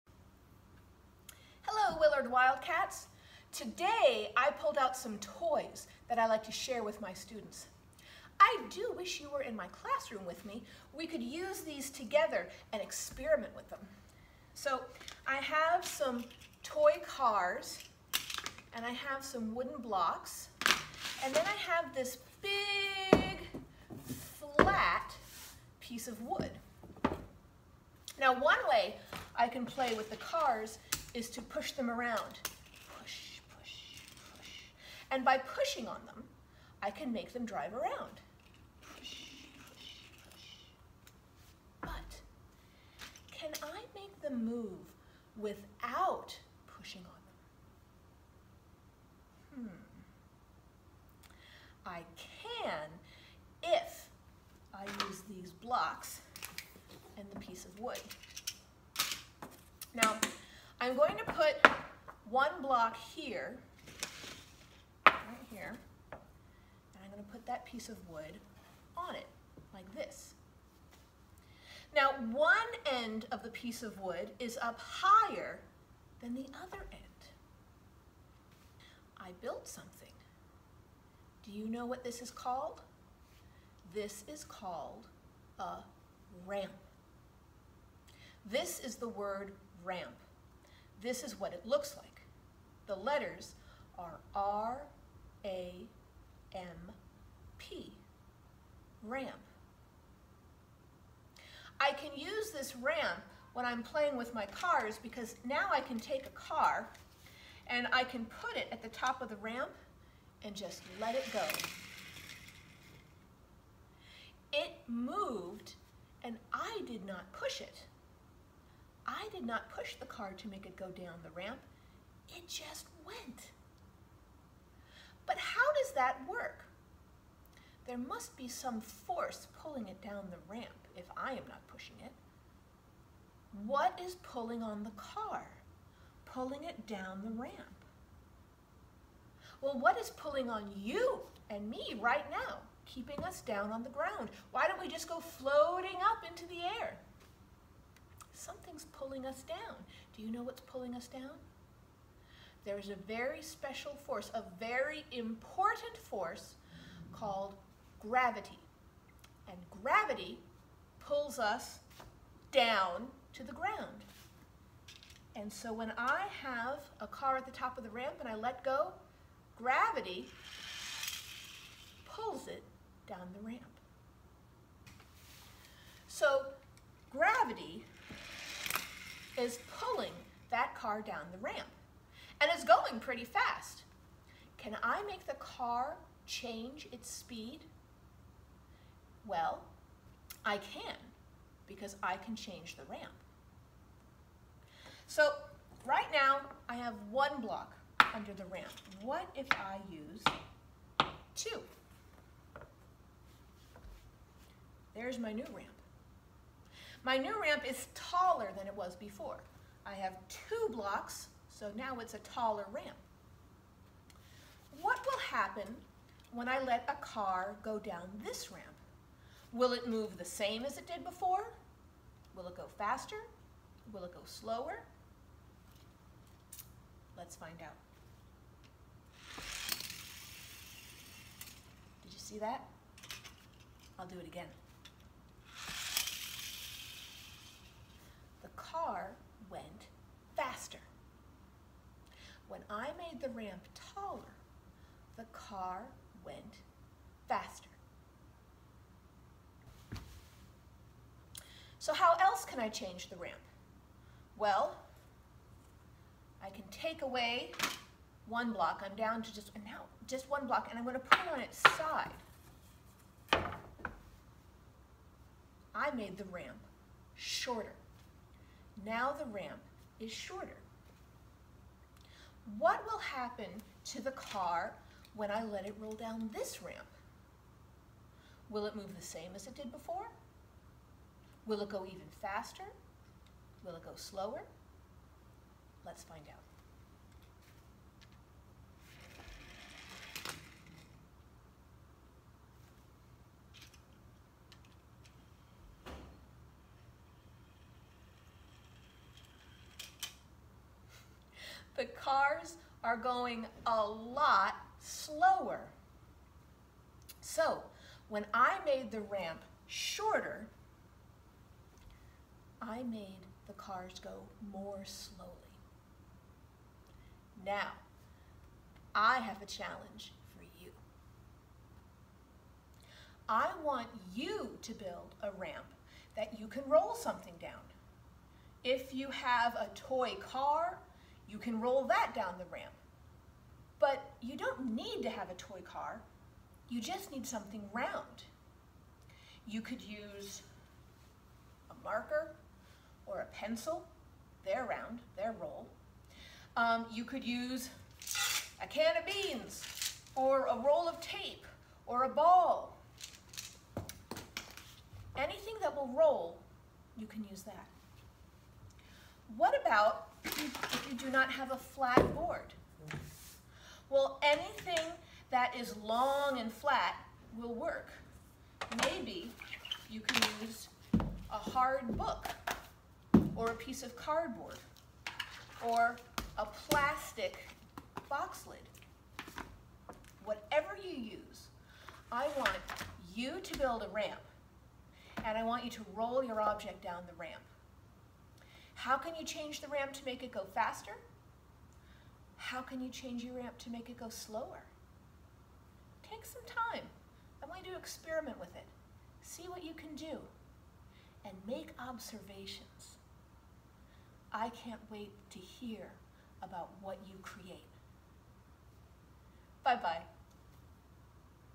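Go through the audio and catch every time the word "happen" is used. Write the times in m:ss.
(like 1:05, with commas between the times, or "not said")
3:35, 4:32.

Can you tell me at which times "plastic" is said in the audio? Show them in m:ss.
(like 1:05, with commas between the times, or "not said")
6:16.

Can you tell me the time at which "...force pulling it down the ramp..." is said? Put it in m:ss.
2:08.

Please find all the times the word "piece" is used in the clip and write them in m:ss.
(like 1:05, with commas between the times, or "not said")
0:25, 0:57, 1:07, 1:13, 6:13.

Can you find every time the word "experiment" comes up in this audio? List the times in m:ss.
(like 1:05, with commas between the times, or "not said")
0:12, 6:37.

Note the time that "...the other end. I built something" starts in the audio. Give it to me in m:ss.
1:16.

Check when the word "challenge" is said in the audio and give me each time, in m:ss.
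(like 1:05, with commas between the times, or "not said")
5:19.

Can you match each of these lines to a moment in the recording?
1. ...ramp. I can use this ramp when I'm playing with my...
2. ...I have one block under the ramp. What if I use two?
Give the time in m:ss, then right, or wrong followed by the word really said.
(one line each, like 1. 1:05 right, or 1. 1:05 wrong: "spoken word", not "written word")
1. 1:39 right
2. 3:16 right.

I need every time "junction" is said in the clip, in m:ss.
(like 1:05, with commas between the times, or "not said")
not said.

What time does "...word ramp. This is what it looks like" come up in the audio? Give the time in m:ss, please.
1:29.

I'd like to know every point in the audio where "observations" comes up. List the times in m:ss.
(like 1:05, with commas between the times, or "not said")
6:41.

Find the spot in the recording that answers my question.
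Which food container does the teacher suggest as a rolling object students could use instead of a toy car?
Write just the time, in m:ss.
5:48.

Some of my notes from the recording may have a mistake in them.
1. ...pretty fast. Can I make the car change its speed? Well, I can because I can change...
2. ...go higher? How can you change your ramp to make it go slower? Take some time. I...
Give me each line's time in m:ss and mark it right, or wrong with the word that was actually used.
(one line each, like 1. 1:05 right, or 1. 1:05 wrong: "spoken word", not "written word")
1. 3:02 right
2. 6:30 wrong: "faster", not "higher".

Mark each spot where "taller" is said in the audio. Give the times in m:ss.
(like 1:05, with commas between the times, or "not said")
3:27, 3:32, 4:03.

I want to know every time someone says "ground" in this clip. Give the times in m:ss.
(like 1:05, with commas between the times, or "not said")
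2:23, 2:43.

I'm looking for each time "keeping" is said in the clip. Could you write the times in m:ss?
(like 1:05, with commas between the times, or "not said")
2:22.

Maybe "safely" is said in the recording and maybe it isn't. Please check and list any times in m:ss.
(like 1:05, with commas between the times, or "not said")
not said.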